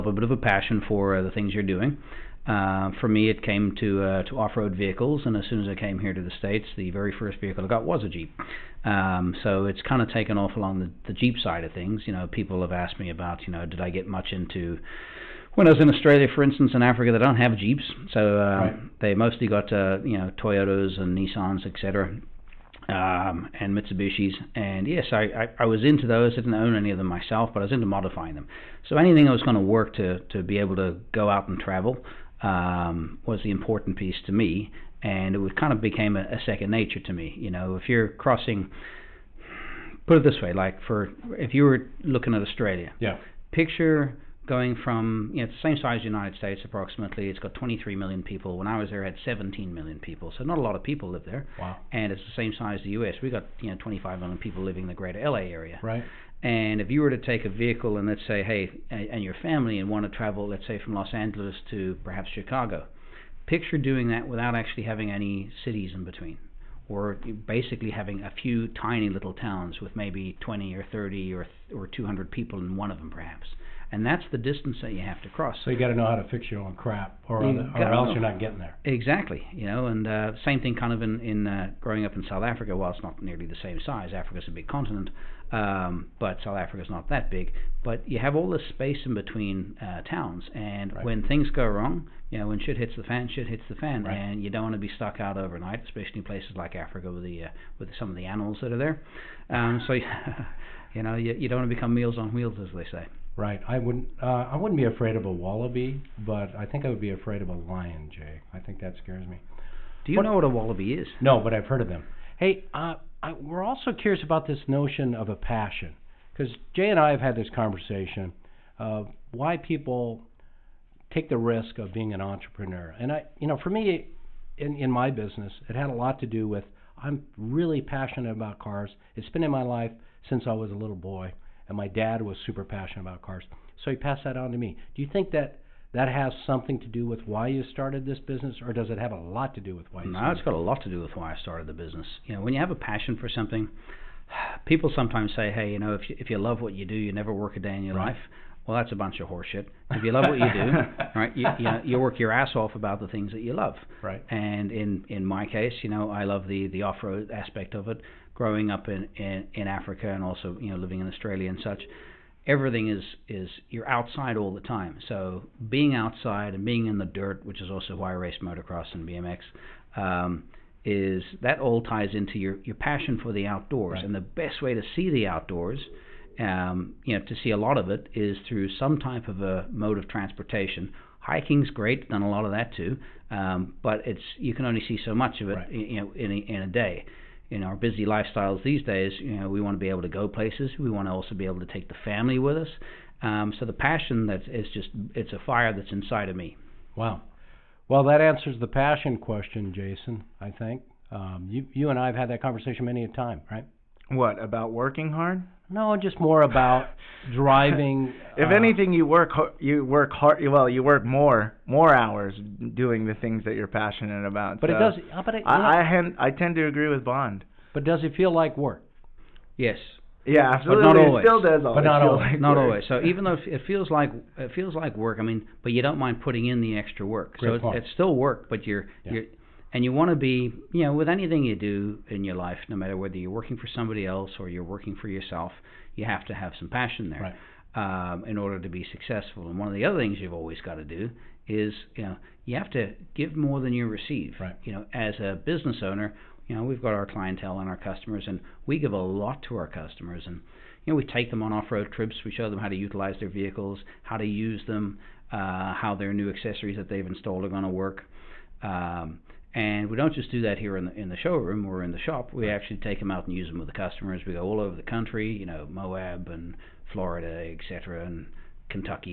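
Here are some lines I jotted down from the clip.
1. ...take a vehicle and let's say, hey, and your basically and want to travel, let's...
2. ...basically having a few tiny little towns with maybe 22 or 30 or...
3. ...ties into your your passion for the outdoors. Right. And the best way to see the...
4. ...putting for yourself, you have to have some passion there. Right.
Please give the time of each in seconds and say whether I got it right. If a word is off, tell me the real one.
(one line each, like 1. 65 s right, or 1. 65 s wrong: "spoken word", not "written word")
1. 57 s wrong: "family", not "basically"
2. 67 s wrong: "20", not "22"
3. 171 s right
4. 234 s wrong: "working", not "putting".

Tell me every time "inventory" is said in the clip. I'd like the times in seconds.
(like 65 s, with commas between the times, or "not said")
not said.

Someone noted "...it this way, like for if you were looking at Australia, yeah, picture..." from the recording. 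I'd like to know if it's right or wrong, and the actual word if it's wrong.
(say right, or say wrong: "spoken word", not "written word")
right.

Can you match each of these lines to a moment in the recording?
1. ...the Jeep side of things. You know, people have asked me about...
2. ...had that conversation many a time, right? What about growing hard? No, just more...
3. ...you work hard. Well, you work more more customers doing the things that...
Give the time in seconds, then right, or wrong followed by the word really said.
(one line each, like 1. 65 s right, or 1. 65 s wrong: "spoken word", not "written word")
1. 11 s right
2. 202 s wrong: "working", not "growing"
3. 209 s wrong: "hours", not "customers".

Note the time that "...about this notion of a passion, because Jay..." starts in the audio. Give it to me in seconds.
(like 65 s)
114 s.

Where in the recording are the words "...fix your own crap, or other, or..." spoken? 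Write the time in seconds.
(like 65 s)
76 s.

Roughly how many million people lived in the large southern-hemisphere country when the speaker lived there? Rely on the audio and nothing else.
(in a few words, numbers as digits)
17 million.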